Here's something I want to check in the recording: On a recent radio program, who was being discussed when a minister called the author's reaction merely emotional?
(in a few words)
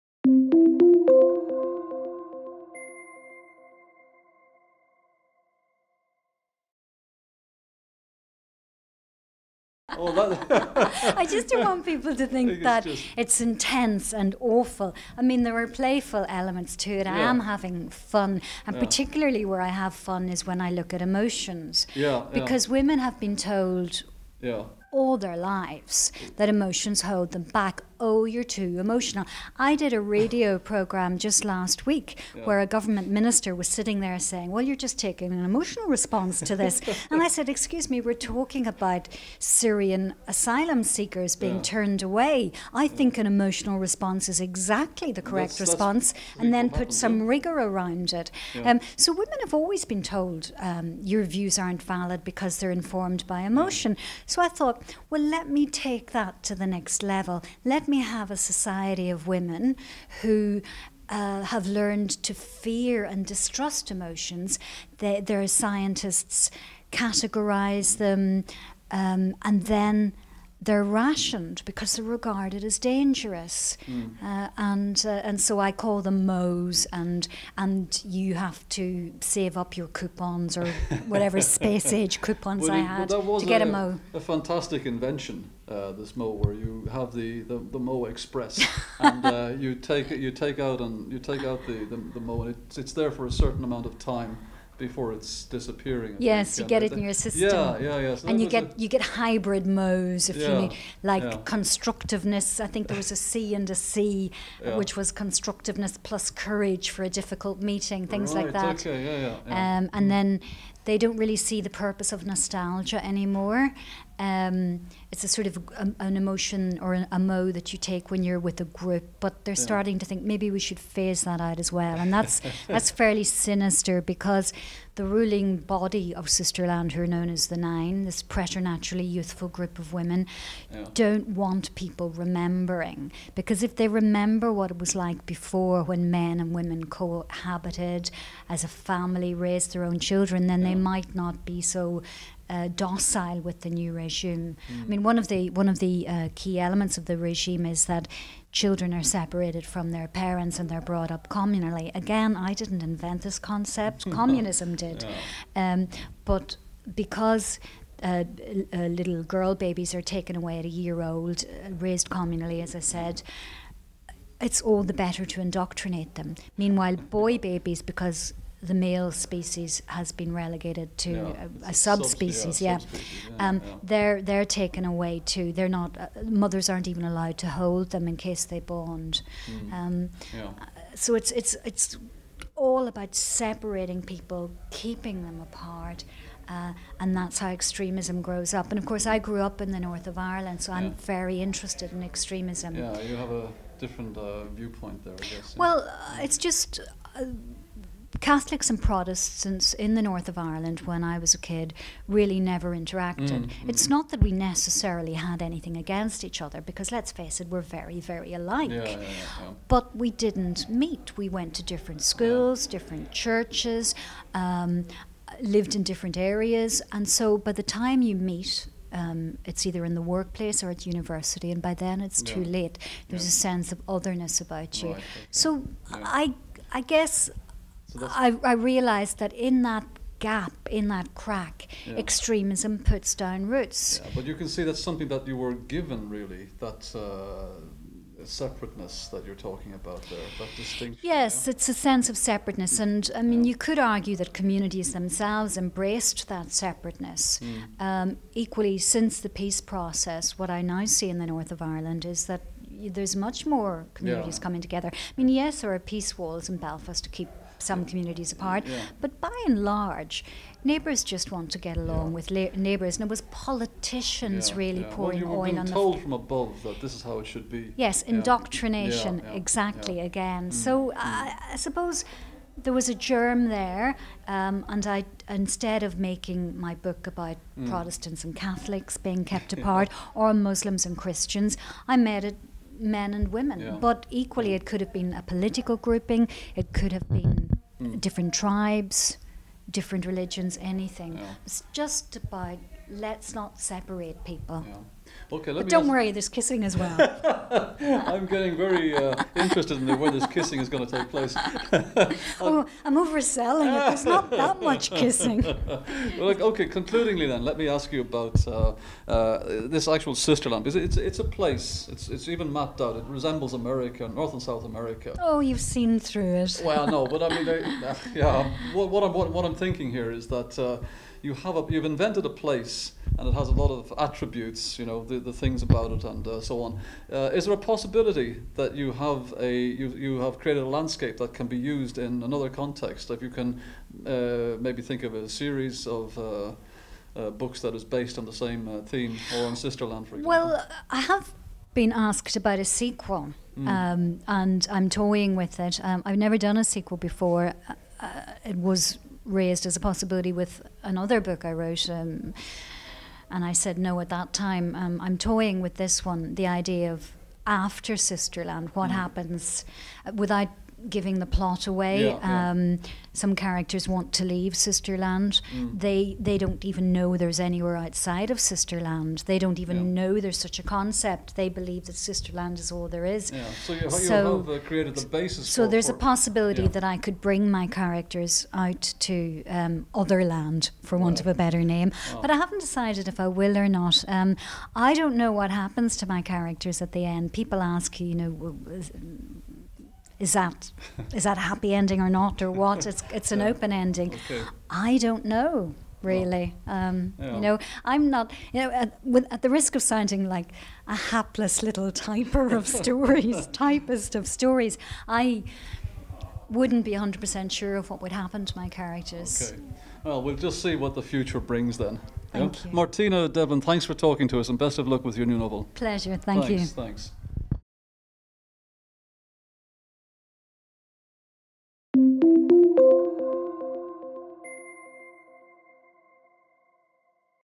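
Syrian asylum seekers.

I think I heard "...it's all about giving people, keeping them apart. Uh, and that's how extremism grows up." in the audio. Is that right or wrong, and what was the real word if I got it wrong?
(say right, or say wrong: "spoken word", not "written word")
wrong: "separating", not "giving".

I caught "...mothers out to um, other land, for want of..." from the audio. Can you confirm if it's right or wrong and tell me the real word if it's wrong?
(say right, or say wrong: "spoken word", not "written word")
wrong: "characters", not "mothers".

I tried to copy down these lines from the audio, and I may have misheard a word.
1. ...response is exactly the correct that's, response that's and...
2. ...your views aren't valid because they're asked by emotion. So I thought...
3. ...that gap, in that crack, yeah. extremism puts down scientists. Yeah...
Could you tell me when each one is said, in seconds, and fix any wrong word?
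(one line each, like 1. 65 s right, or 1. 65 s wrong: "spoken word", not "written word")
1. 43 s right
2. 51 s wrong: "informed", not "asked"
3. 229 s wrong: "roots", not "scientists".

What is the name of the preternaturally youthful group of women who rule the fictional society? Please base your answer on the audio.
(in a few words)
the Nine.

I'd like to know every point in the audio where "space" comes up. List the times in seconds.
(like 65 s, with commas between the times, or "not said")
81 s.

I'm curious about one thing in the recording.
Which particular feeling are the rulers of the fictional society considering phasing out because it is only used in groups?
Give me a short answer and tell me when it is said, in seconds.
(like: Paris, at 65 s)
nostalgia, at 112 s.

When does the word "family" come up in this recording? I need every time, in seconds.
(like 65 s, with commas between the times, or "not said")
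138 s.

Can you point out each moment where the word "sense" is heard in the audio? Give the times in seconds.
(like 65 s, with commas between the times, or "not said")
223 s, 241 s.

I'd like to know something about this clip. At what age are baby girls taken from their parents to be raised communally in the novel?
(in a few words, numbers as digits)
1 year old.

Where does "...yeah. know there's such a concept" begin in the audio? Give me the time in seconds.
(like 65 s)
369 s.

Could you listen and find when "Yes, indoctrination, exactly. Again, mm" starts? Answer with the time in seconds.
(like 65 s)
267 s.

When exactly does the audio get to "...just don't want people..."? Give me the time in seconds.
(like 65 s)
11 s.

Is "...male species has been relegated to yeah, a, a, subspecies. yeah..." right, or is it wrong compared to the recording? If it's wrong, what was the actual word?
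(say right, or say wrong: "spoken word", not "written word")
right.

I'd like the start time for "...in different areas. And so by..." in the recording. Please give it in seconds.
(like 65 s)
215 s.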